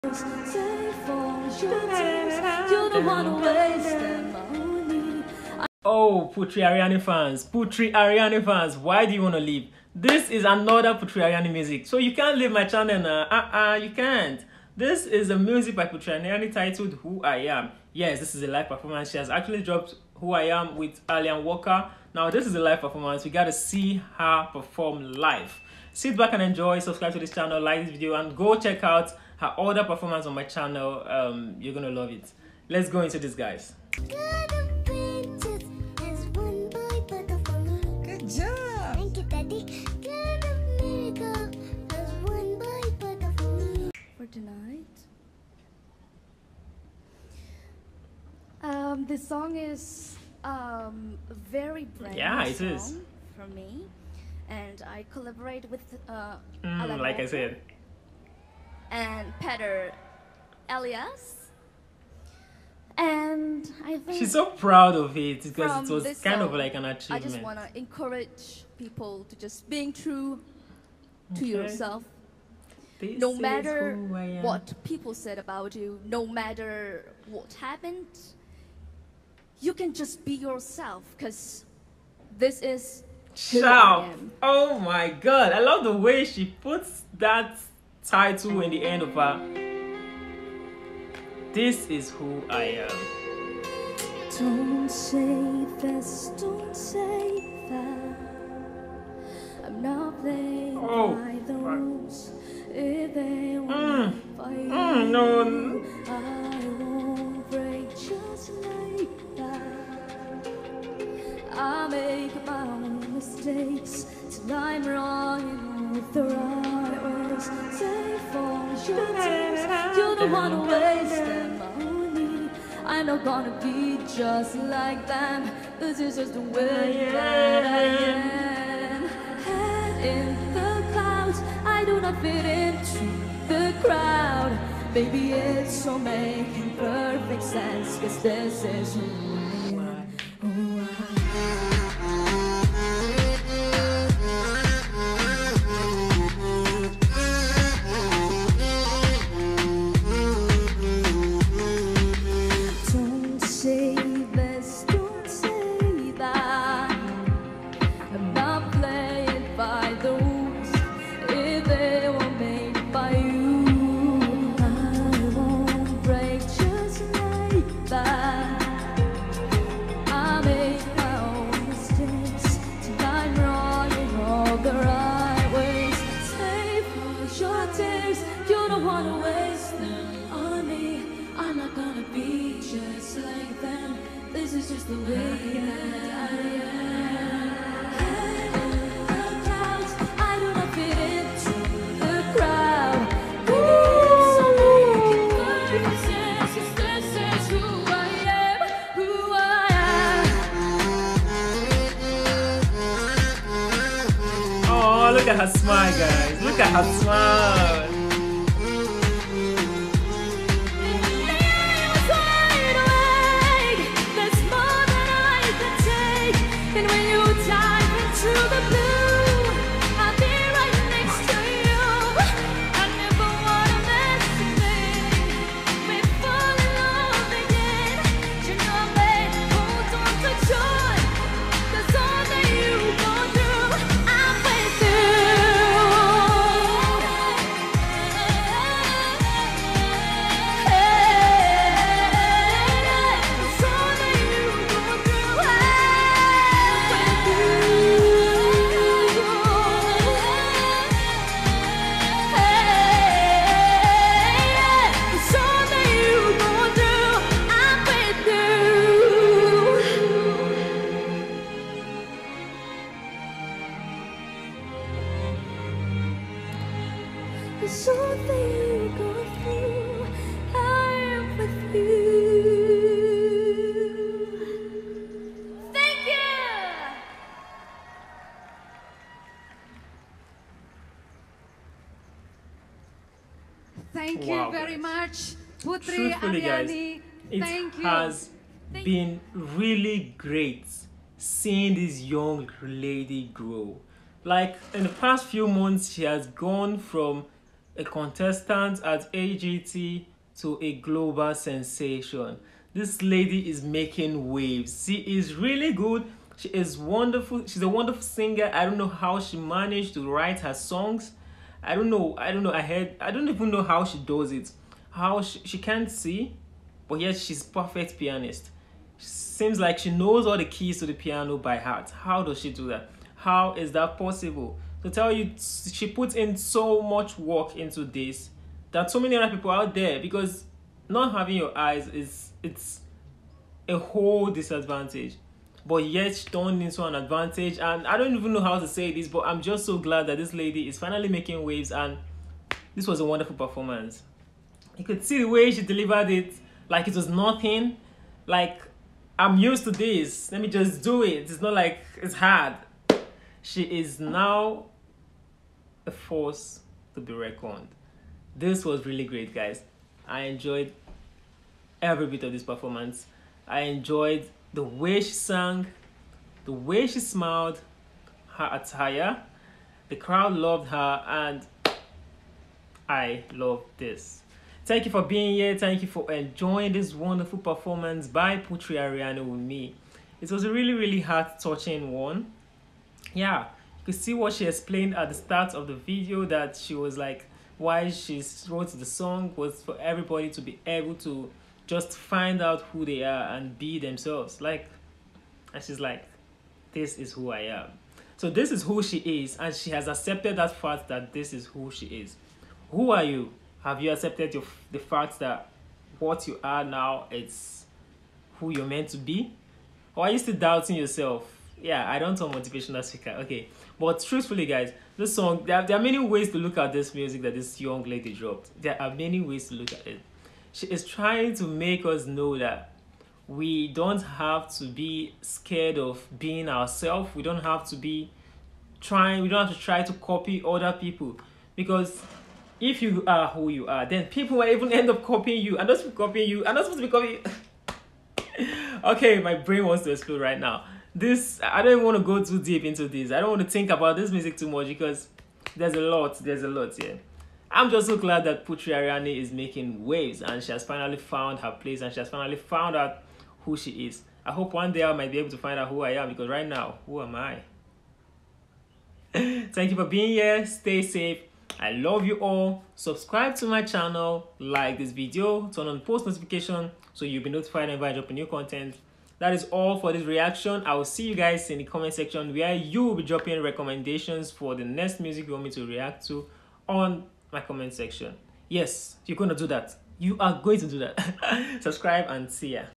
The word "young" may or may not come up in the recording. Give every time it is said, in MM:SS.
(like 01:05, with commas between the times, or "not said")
04:52, 06:57.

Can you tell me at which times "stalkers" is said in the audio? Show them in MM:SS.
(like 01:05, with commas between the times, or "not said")
not said.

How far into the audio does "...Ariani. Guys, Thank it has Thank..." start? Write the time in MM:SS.
04:46.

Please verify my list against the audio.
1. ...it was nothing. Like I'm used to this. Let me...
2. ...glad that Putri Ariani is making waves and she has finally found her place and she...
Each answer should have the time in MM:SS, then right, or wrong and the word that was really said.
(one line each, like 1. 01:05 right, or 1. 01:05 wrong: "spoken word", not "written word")
1. 05:46 right
2. 07:27 right.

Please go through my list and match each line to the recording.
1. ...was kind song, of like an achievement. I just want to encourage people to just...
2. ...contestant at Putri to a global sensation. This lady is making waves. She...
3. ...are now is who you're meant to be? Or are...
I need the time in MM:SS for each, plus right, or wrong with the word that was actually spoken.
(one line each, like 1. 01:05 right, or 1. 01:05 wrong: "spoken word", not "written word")
1. 01:05 right
2. 04:57 wrong: "AGT", not "Putri"
3. 06:46 right.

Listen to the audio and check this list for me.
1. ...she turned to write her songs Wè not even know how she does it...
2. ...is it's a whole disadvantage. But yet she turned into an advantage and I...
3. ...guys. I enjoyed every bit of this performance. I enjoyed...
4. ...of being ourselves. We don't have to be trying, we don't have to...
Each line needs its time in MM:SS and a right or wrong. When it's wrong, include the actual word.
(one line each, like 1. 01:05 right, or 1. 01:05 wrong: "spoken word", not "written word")
1. 05:09 wrong: "managed", not "turned"
2. 05:31 right
3. 05:59 right
4. 07:05 right.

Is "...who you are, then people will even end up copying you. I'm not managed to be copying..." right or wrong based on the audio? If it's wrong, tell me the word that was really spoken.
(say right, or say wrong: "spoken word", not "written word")
wrong: "supposed", not "managed".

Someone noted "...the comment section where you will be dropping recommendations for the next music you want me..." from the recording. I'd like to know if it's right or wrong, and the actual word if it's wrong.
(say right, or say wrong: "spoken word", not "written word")
right.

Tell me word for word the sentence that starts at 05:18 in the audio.
She knows all the keys by heart.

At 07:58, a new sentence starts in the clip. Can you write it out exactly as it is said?
Yes, you're going to do that.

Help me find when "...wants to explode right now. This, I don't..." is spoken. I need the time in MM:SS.
07:19.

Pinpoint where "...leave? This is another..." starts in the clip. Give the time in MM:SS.
00:09.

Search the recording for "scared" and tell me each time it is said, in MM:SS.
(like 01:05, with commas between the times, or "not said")
07:05.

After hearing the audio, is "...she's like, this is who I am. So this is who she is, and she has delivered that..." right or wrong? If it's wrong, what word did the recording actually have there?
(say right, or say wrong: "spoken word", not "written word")
wrong: "accepted", not "delivered".